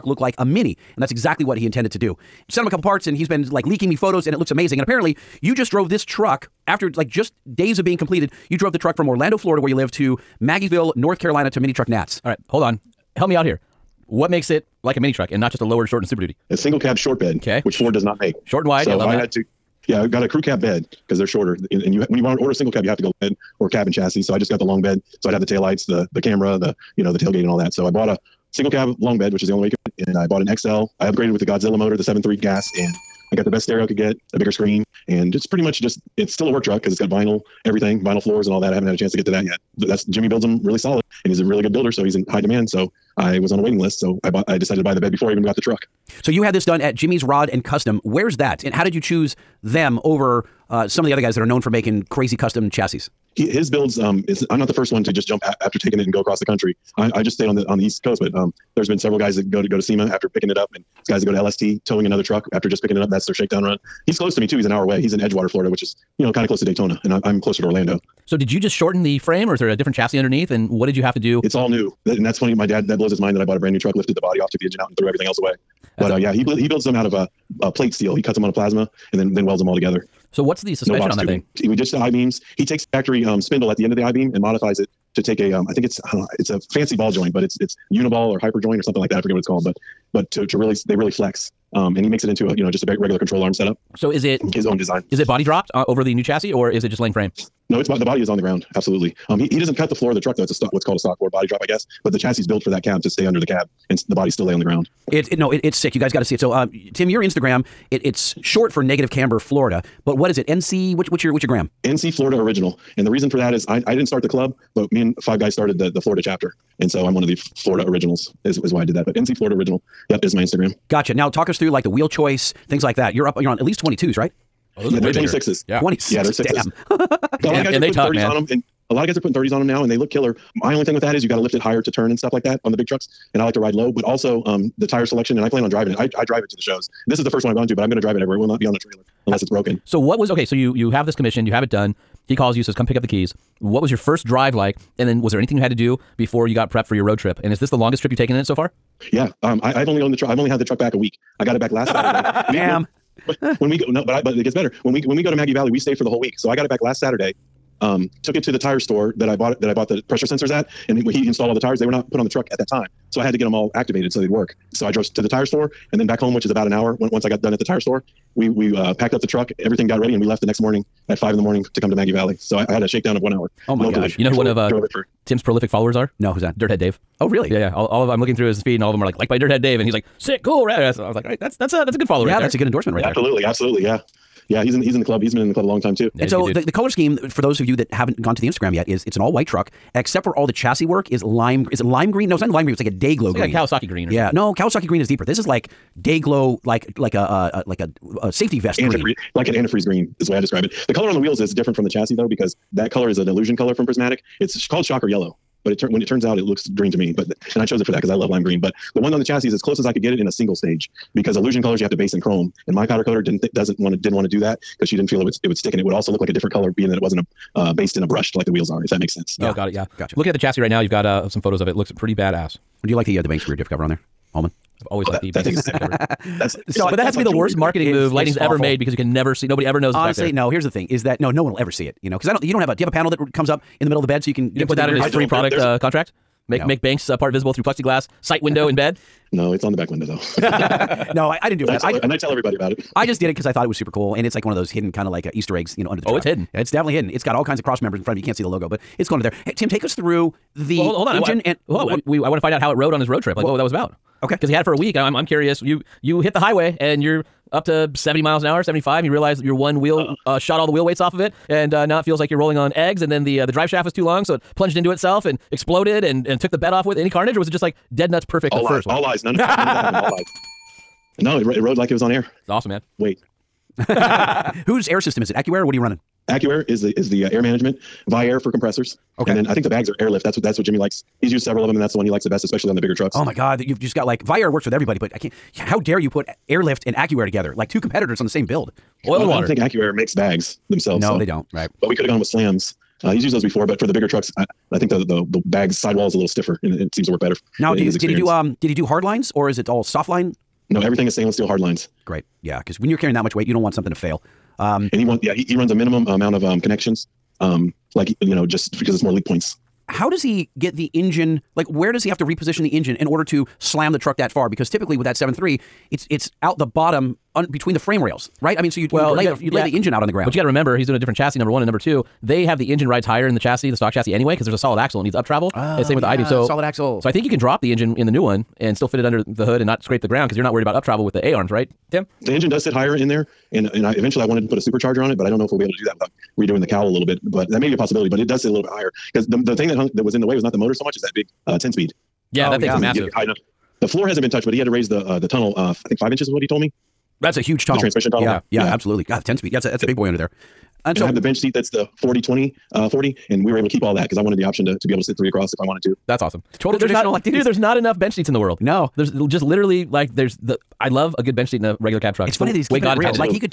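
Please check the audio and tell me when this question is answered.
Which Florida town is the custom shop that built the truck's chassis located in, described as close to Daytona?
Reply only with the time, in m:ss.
1:05.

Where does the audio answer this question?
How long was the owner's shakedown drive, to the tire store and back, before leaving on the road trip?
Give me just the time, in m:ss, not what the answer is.
2:53.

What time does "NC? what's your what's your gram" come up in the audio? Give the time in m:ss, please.
1:50.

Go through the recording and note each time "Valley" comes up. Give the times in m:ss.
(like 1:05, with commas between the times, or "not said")
2:35, 2:52.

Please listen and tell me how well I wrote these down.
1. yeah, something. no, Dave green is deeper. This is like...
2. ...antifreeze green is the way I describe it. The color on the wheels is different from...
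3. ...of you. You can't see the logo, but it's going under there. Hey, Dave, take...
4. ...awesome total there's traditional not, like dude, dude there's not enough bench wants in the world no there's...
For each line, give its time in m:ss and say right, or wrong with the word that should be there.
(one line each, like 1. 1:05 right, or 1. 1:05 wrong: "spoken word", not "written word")
1. 3:14 wrong: "Kawasaki", not "Dave"
2. 3:19 right
3. 4:08 wrong: "Tim", not "Dave"
4. 5:56 wrong: "seats", not "wants".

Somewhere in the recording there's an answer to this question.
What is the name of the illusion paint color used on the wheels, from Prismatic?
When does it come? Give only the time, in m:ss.
3:24.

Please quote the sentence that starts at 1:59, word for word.
But NC Florida original, yep, is my Instagram.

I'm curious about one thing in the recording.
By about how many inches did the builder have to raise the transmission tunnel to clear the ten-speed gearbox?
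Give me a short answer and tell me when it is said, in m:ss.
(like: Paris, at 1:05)
5, at 5:45.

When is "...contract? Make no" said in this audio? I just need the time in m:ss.
3:55.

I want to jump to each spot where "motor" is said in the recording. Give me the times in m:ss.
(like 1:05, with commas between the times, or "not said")
0:31, 5:40.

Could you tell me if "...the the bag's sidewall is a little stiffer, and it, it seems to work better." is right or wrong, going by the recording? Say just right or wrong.
right.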